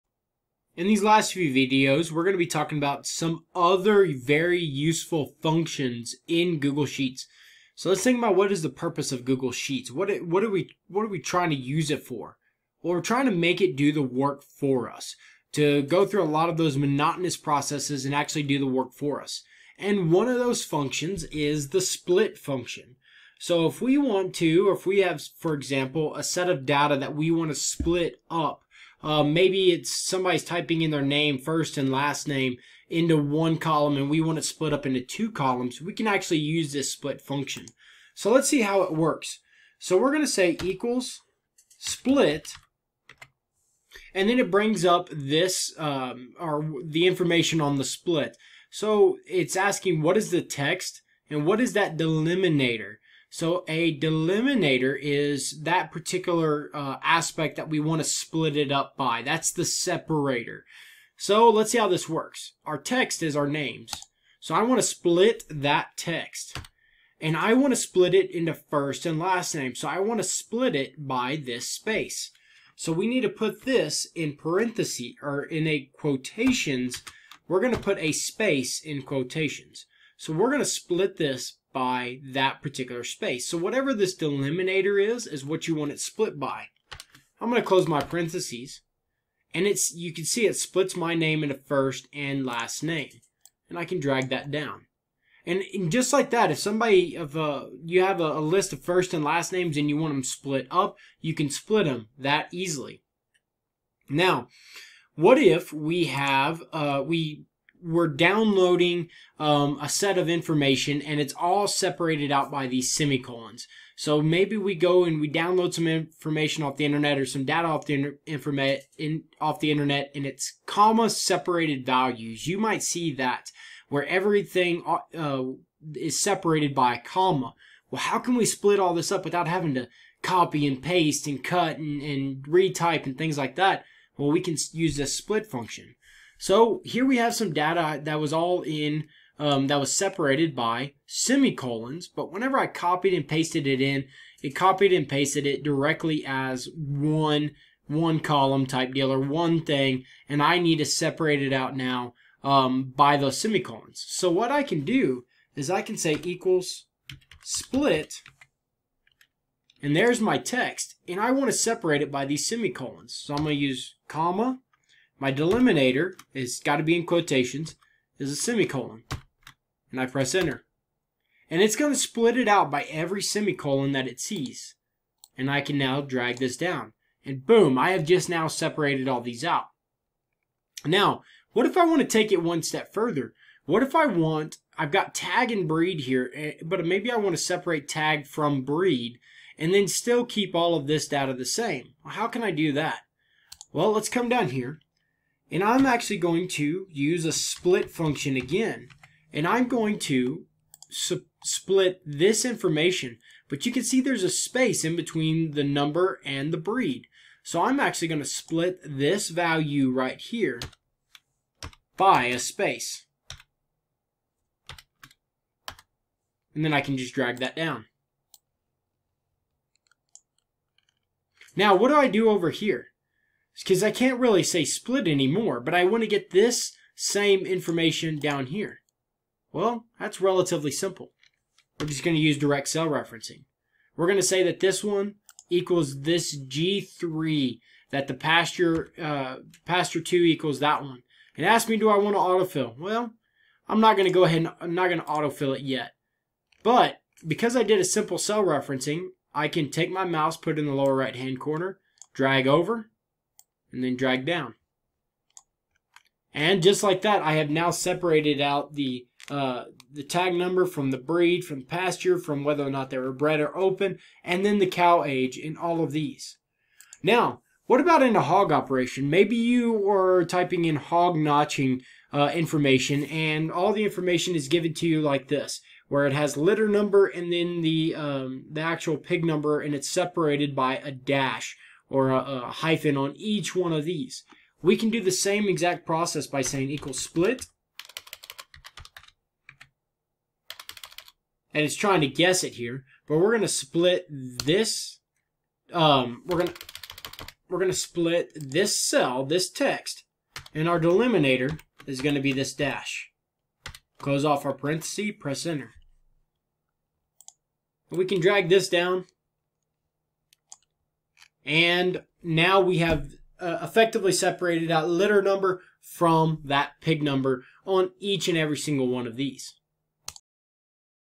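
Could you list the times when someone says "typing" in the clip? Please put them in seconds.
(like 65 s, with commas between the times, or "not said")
30 s, 270 s.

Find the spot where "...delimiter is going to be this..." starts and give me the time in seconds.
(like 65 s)
300 s.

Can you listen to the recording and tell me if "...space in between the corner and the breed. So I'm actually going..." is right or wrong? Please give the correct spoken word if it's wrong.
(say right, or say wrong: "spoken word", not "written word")
wrong: "number", not "corner".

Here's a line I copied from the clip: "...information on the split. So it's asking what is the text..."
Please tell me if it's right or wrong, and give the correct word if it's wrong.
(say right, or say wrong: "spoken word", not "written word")
right.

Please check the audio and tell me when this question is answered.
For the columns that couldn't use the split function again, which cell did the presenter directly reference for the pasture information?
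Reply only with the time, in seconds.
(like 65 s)
236 s.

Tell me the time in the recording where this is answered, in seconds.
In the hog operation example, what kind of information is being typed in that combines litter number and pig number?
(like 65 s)
270 s.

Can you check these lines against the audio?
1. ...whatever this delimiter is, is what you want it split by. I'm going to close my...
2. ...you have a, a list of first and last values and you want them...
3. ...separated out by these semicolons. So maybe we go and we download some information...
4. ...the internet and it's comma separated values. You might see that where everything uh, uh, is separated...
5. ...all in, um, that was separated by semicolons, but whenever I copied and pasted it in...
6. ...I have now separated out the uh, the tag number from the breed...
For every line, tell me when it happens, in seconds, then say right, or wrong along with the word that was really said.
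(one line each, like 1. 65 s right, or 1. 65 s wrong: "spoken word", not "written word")
1. 83 s right
2. 97 s wrong: "names", not "values"
3. 111 s right
4. 119 s right
5. 138 s right
6. 257 s right.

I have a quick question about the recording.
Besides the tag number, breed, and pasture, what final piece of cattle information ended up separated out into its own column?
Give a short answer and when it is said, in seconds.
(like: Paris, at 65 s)
Cow age, at 264 s.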